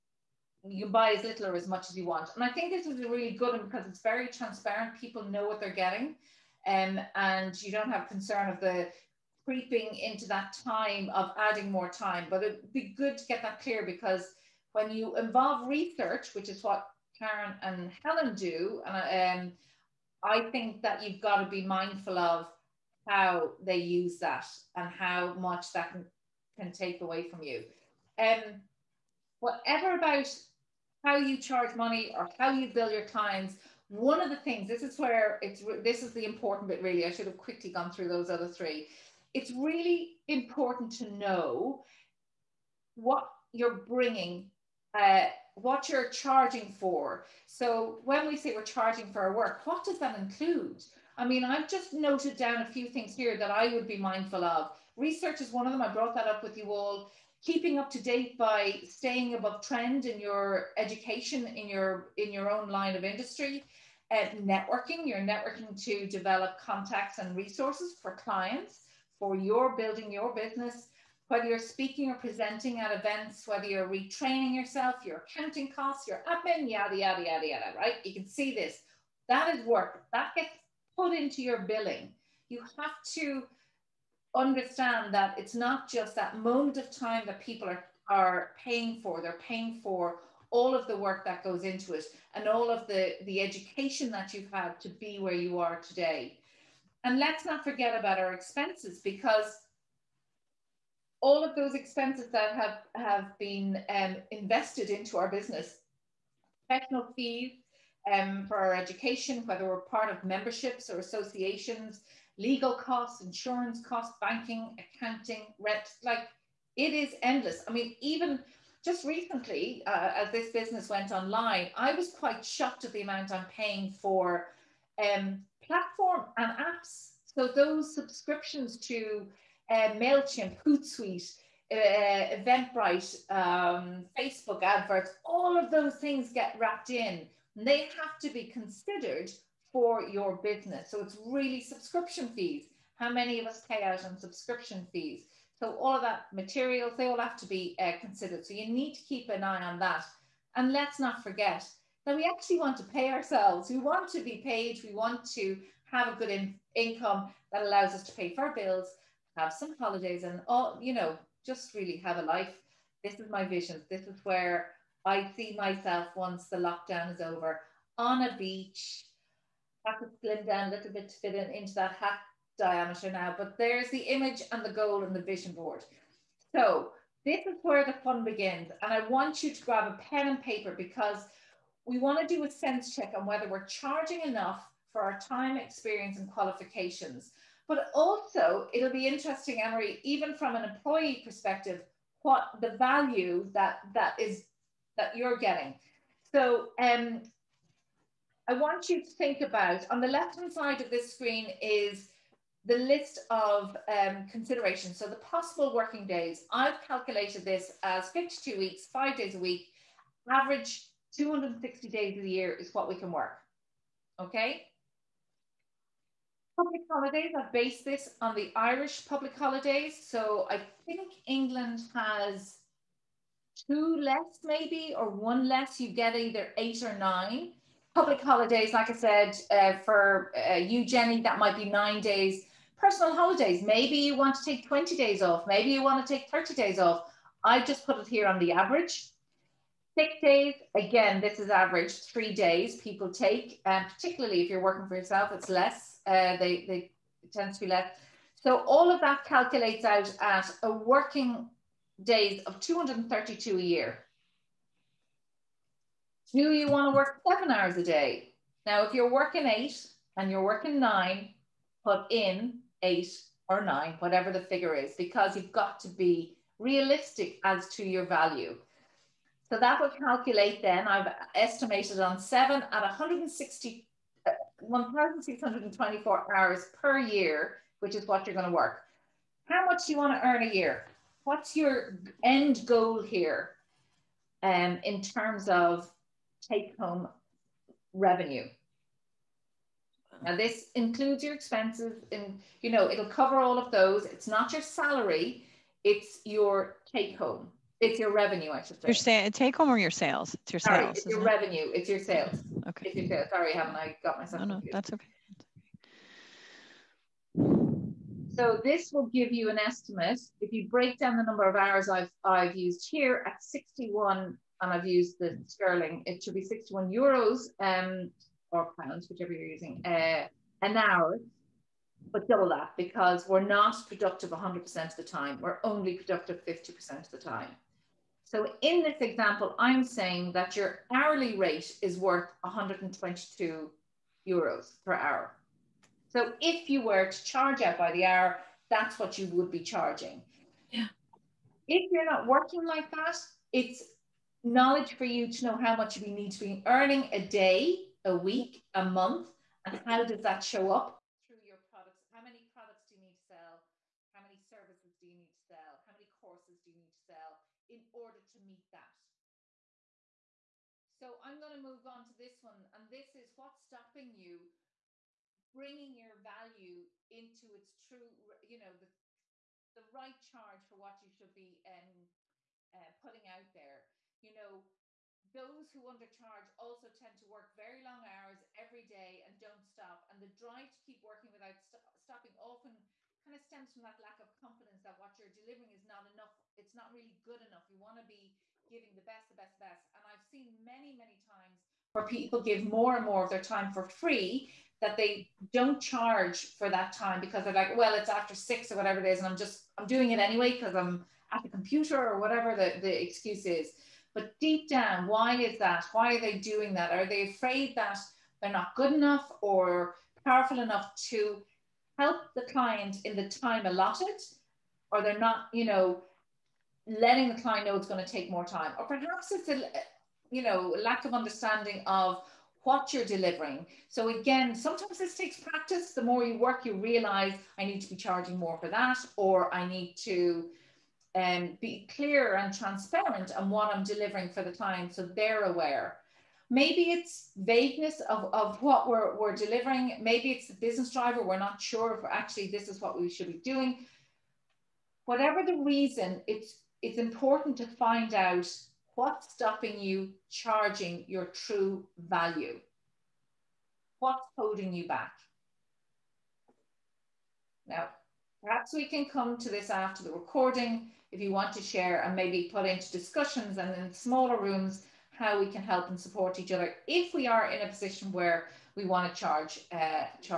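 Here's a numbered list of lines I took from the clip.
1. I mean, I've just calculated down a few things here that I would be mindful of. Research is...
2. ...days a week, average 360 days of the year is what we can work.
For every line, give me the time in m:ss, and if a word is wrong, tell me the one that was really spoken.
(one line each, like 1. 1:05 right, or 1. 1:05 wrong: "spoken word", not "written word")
1. 0:51 wrong: "noted", not "calculated"
2. 3:29 wrong: "260", not "360".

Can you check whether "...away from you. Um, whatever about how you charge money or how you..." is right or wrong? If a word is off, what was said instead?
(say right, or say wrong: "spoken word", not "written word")
right.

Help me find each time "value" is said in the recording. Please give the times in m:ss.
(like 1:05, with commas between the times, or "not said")
3:12, 4:28, 6:06, 7:32.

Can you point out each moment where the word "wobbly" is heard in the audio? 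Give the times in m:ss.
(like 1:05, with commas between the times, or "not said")
not said.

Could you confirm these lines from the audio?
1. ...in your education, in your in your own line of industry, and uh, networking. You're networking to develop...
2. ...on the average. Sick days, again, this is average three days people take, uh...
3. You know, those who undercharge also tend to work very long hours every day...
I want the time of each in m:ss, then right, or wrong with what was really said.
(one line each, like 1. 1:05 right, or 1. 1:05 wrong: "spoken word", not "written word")
1. 1:00 right
2. 3:58 right
3. 6:14 right.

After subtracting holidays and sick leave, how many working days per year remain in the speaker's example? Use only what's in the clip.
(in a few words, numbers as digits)
232.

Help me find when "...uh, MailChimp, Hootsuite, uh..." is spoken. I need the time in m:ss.
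2:09.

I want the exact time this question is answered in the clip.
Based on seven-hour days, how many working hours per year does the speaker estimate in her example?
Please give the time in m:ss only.
4:34.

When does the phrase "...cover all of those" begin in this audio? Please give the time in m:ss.
4:53.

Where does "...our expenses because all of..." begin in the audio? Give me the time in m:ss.
1:38.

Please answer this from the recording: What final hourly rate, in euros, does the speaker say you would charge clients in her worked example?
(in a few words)
122 euros.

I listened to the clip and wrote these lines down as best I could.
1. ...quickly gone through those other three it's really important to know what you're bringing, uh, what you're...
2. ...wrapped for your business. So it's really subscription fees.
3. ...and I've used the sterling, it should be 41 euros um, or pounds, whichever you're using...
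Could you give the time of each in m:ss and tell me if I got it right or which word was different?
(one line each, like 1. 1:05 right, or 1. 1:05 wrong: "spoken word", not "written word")
1. 0:37 right
2. 2:18 wrong: "considered", not "wrapped"
3. 5:14 wrong: "61", not "41".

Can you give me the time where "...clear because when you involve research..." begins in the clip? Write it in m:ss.
0:13.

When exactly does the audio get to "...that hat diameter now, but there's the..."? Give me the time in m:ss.
2:51.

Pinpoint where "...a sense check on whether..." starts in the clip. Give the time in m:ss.
3:02.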